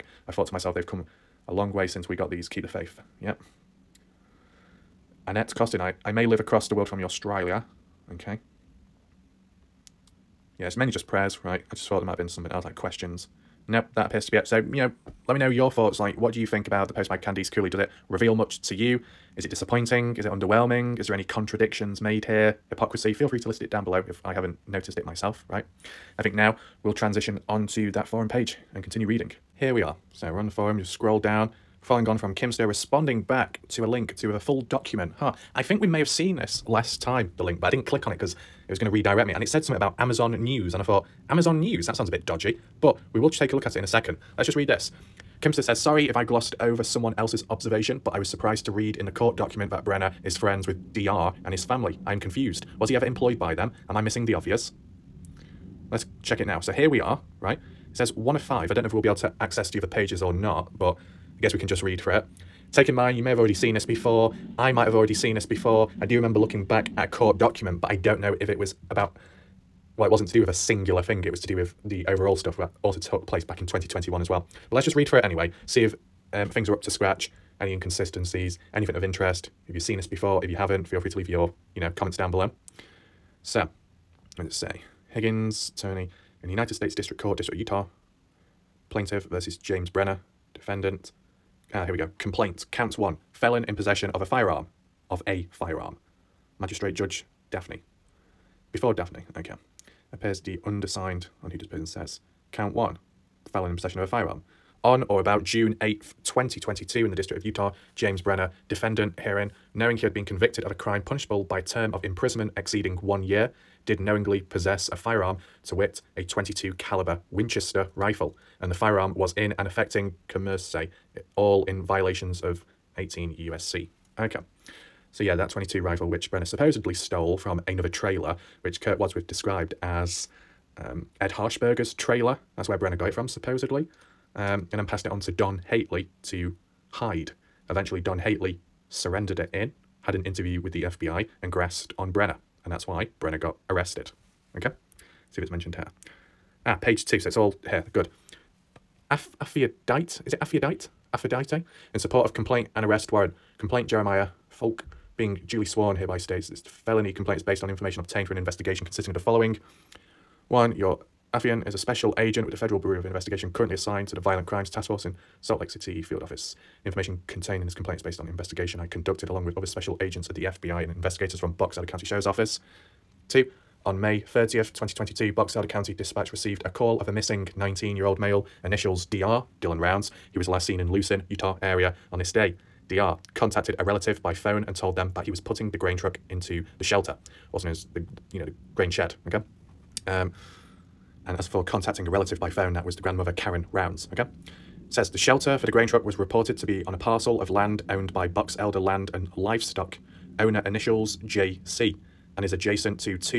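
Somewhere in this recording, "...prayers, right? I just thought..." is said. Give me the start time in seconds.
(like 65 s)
11 s.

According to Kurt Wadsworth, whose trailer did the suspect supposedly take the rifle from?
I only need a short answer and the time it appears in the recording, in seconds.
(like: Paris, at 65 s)
Ed Harshberger, at 131 s.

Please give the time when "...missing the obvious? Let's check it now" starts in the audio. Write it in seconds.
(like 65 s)
54 s.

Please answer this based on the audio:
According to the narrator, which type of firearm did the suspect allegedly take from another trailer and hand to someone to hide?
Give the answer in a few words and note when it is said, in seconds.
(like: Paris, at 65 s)
22 caliber Winchester rifle, at 116 s.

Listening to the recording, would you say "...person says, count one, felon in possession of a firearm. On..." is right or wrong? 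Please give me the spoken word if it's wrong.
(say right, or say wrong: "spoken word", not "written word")
right.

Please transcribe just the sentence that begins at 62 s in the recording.
Taking mind, you may have already seen this before.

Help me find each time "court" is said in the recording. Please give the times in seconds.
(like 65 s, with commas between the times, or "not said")
49 s, 67 s, 87 s.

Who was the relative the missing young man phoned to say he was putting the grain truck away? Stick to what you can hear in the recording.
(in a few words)
Karen Rounds.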